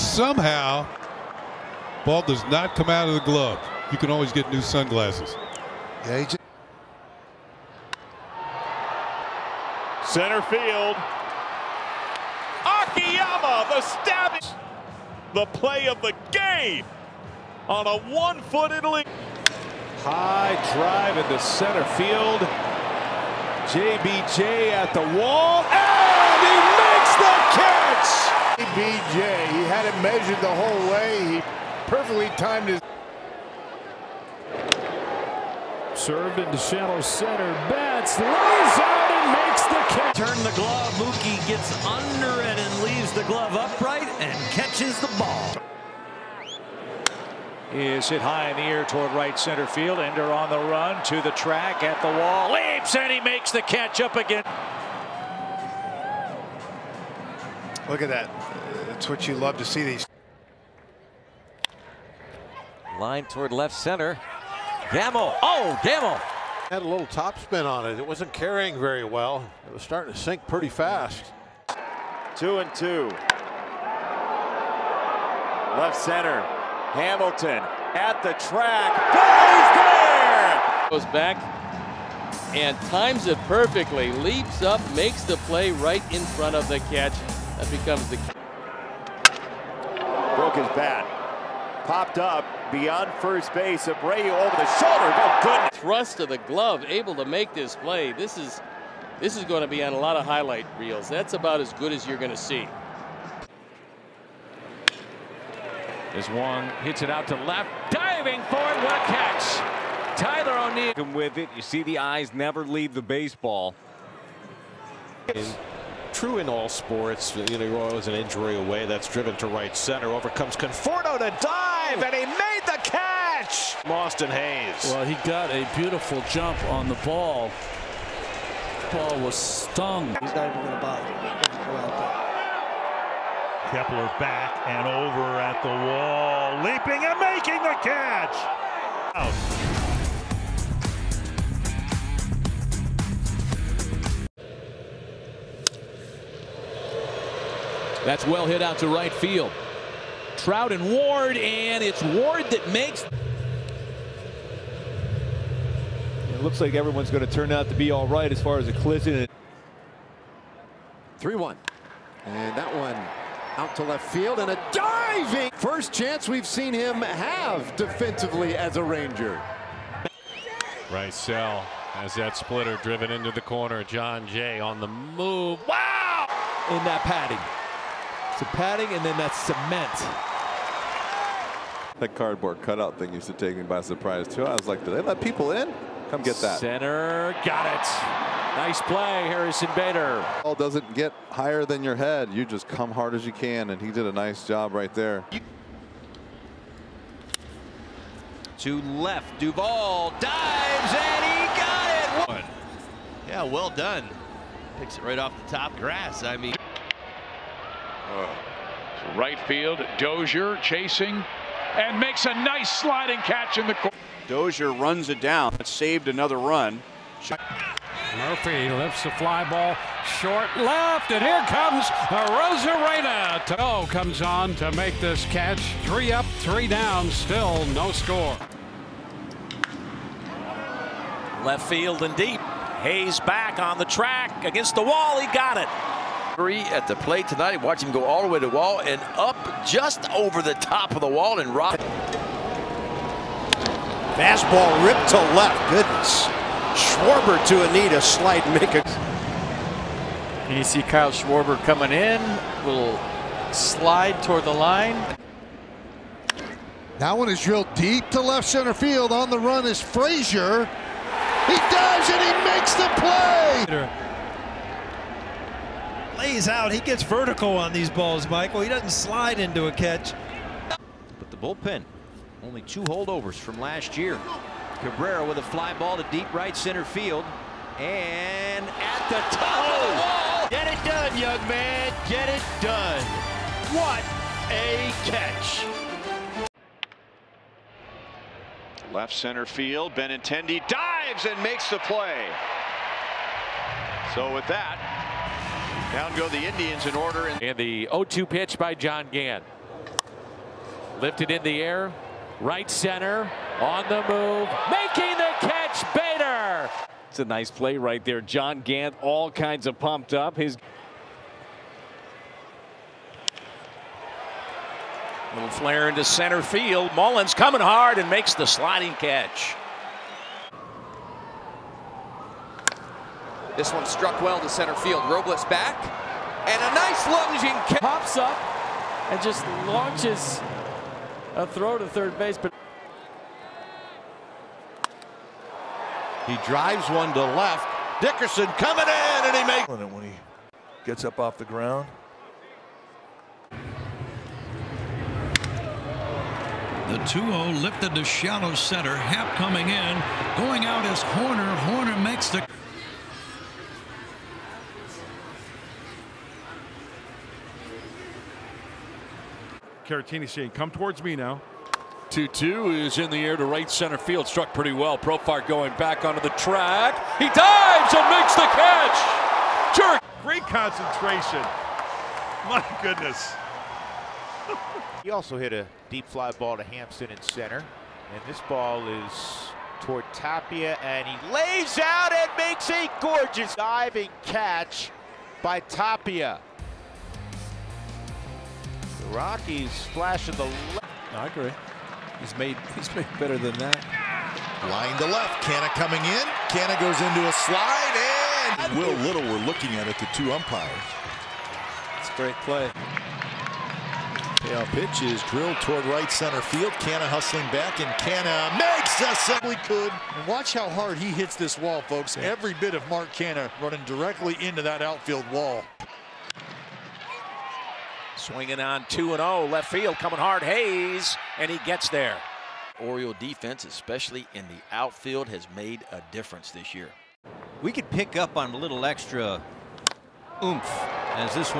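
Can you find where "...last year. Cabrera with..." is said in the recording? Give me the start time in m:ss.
4:33.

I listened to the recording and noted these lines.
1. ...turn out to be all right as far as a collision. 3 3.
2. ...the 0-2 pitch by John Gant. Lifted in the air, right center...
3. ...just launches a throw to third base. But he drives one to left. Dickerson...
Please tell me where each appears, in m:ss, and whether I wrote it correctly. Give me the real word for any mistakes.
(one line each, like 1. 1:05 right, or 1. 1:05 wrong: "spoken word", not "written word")
1. 2:37 wrong: "1", not "3"
2. 4:57 right
3. 5:29 right.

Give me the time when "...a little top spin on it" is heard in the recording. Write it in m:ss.
1:06.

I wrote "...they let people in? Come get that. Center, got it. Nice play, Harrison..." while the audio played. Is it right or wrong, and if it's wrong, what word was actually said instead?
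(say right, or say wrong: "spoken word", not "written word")
right.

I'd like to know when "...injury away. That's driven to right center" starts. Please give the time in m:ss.
1:58.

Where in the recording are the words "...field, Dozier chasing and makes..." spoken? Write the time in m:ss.
3:29.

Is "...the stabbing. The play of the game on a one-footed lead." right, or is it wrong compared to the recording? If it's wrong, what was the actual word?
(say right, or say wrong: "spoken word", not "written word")
right.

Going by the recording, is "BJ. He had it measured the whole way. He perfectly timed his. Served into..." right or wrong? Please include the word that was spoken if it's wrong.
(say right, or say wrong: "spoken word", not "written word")
right.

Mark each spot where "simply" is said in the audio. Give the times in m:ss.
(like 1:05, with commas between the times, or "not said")
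6:49.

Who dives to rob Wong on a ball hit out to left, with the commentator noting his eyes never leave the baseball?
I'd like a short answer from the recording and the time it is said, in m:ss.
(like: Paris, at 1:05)
Tyler O'Neill, at 1:50.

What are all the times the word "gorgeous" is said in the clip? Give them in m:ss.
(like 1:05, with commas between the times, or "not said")
6:23.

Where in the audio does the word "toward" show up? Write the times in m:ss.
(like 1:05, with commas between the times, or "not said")
0:48, 1:03, 4:14, 6:00, 6:19, 6:45.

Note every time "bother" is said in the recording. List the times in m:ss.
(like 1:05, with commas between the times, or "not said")
2:10.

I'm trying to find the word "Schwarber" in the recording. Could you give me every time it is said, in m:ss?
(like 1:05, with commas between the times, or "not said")
4:06, 4:11.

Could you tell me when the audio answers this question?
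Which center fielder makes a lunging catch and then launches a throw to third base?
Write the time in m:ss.
5:25.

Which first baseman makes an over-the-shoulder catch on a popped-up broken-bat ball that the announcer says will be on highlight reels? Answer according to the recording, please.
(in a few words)
Abreu.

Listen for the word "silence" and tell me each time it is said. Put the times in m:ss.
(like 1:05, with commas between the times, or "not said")
not said.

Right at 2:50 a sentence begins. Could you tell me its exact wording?
Rysell has that splitter driven into the corner.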